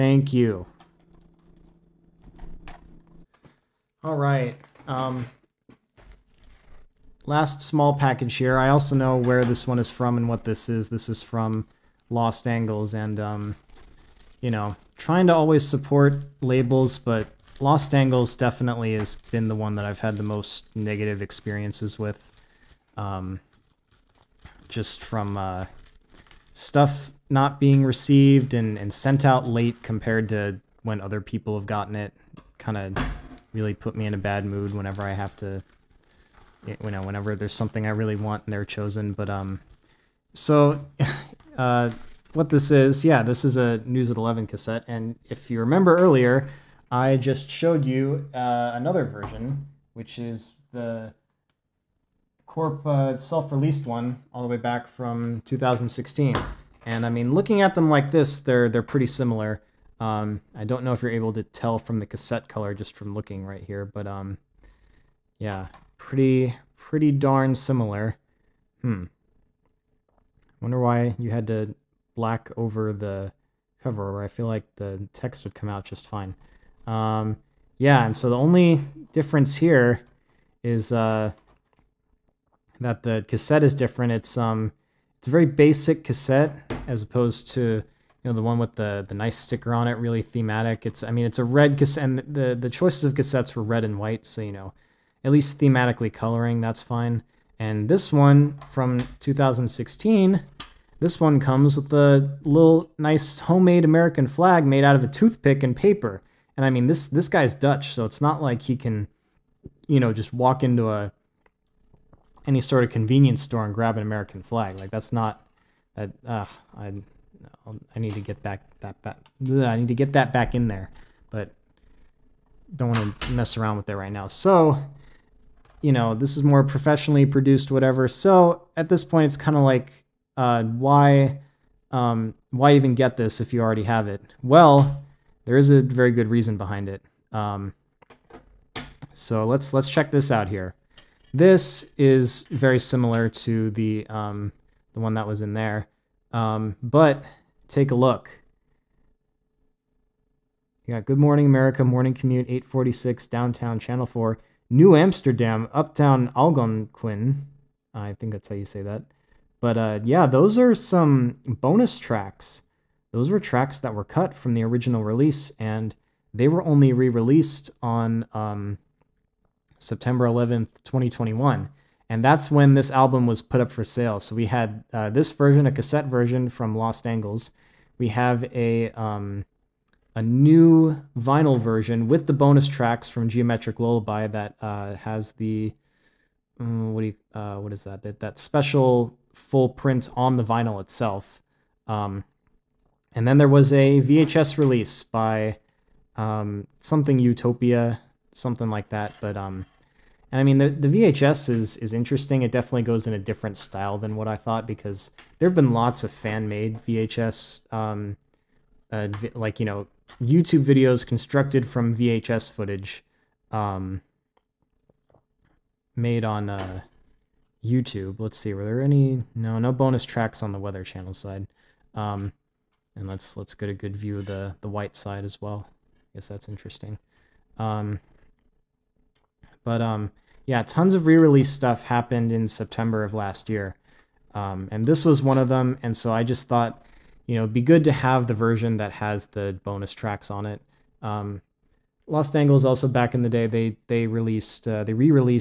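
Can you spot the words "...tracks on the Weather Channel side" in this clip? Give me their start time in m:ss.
3:40.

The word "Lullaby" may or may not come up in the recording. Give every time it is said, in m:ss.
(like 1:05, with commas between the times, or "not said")
3:03.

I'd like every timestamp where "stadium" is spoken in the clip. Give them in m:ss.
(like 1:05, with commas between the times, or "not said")
not said.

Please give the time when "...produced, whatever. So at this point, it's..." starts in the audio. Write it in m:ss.
2:07.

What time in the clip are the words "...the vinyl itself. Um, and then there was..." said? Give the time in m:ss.
3:10.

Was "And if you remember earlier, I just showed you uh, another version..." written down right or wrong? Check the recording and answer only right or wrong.
right.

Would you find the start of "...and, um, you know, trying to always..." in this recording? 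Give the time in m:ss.
0:12.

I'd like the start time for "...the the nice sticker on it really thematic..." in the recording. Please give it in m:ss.
1:28.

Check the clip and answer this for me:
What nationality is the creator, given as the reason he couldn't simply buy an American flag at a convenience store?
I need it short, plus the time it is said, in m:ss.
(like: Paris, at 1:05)
Dutch, at 1:47.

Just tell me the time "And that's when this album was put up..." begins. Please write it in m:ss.
2:52.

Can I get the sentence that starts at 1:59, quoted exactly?
Bleh, I need to get that back in there, but don't want to mess around with it right now.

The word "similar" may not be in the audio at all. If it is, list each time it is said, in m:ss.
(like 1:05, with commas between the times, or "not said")
0:59, 1:07, 2:22.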